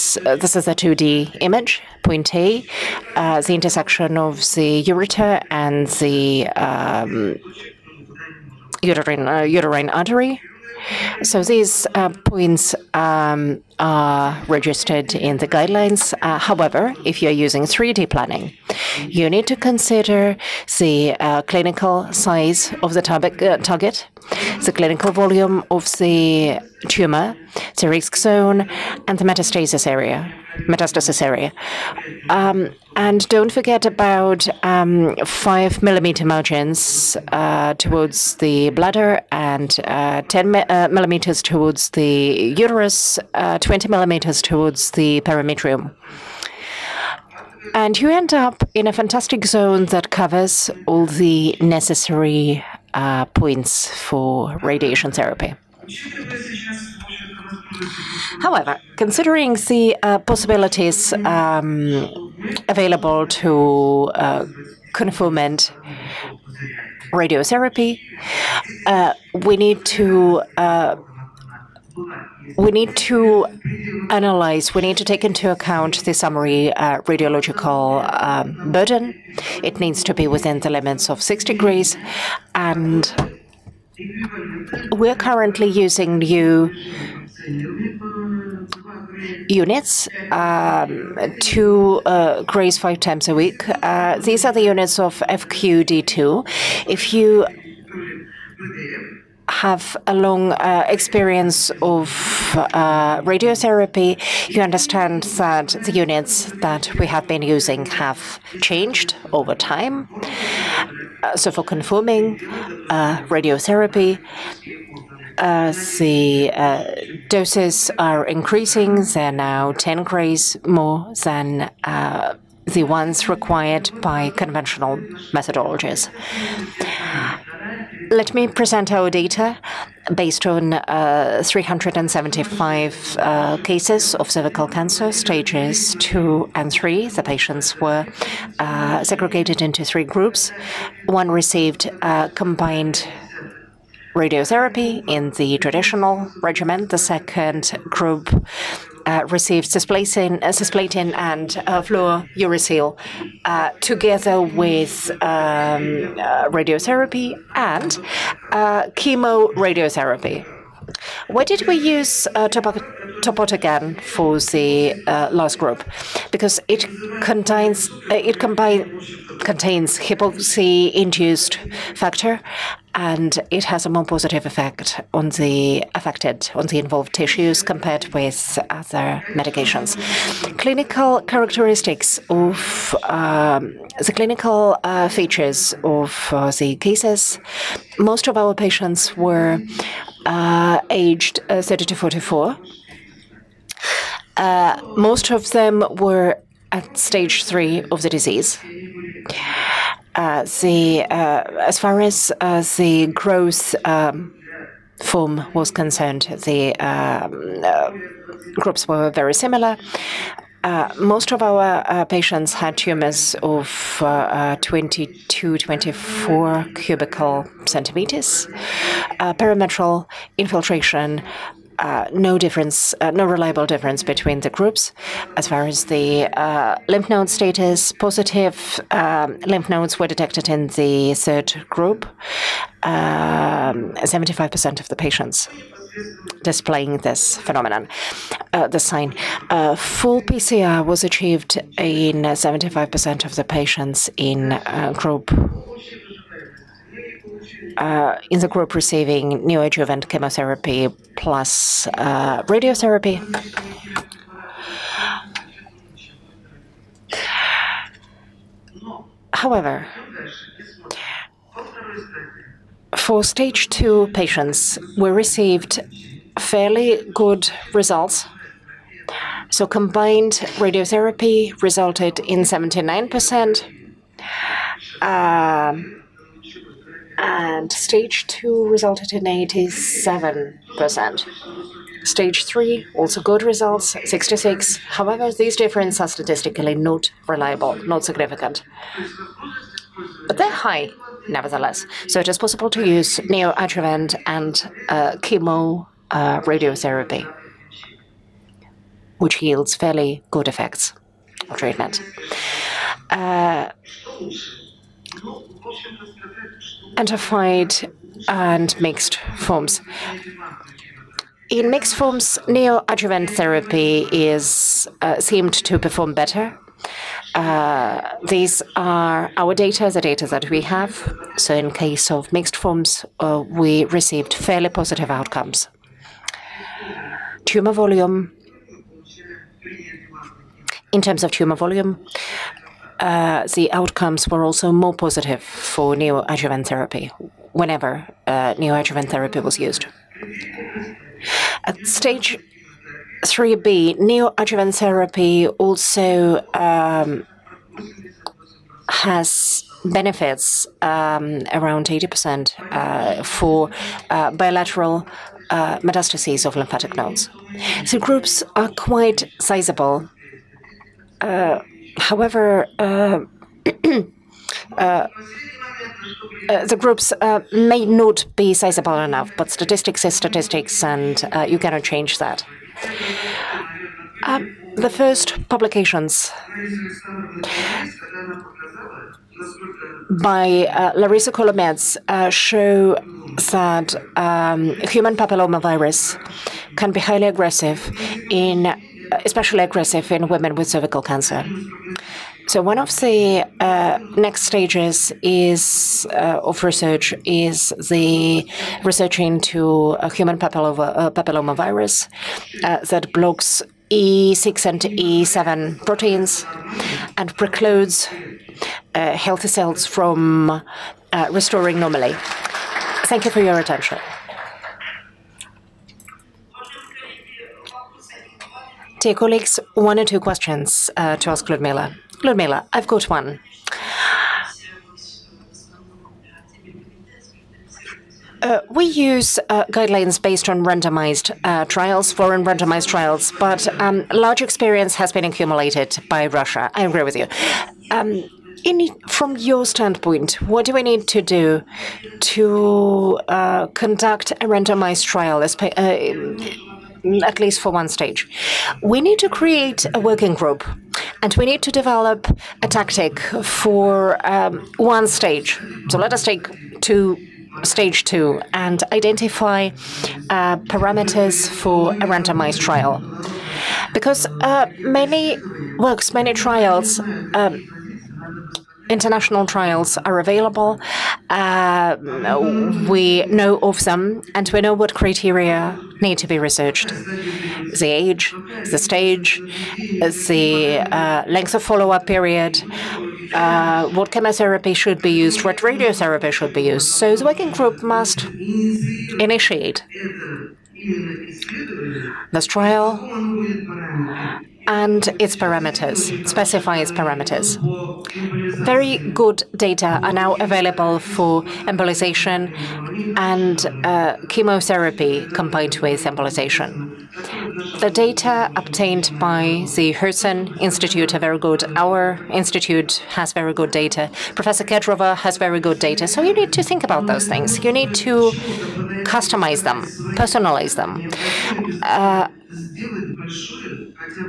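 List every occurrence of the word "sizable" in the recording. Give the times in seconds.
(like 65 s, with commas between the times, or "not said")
359 s, 368 s.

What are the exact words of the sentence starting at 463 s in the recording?
Because uh, many works, many trials um, international trials are available.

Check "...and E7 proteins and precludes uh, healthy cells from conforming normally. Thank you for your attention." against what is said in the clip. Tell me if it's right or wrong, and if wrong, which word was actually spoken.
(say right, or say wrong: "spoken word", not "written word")
wrong: "restoring", not "conforming".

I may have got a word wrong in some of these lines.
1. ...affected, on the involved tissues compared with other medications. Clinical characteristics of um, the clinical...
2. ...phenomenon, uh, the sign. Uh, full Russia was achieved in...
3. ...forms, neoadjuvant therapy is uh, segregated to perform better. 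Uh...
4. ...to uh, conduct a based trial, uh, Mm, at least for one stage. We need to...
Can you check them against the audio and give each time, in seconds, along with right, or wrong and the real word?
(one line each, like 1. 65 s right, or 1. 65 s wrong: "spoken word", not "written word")
1. 175 s right
2. 237 s wrong: "PCR", not "Russia"
3. 311 s wrong: "seemed", not "segregated"
4. 442 s wrong: "randomized", not "based".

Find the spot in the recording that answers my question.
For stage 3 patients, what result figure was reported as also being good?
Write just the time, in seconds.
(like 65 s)
284 s.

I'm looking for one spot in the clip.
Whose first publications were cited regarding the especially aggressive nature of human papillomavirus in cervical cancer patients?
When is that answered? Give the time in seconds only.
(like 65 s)
380 s.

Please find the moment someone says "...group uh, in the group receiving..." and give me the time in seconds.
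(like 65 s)
244 s.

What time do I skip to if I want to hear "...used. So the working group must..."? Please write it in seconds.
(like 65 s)
486 s.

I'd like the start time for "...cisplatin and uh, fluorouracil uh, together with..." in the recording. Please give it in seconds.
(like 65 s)
150 s.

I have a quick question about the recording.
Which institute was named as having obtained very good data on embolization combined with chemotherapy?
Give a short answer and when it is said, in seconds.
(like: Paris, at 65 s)
Herzen Institute, at 509 s.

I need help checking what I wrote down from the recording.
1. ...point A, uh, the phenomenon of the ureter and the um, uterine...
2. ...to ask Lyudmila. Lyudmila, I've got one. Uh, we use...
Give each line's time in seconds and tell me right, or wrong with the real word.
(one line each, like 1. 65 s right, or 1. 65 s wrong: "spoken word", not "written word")
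1. 2 s wrong: "intersection", not "phenomenon"
2. 421 s right.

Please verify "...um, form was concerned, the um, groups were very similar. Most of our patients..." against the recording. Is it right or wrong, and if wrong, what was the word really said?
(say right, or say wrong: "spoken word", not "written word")
right.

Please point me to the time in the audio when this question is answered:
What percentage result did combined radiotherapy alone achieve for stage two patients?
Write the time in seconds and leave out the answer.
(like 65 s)
272 s.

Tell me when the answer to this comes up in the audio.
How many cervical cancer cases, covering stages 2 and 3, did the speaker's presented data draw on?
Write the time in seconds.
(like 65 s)
131 s.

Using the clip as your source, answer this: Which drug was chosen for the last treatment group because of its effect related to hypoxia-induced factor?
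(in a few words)
topotecan.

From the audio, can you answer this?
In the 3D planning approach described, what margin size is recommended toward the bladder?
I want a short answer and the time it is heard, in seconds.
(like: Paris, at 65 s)
5 millimeters, at 35 s.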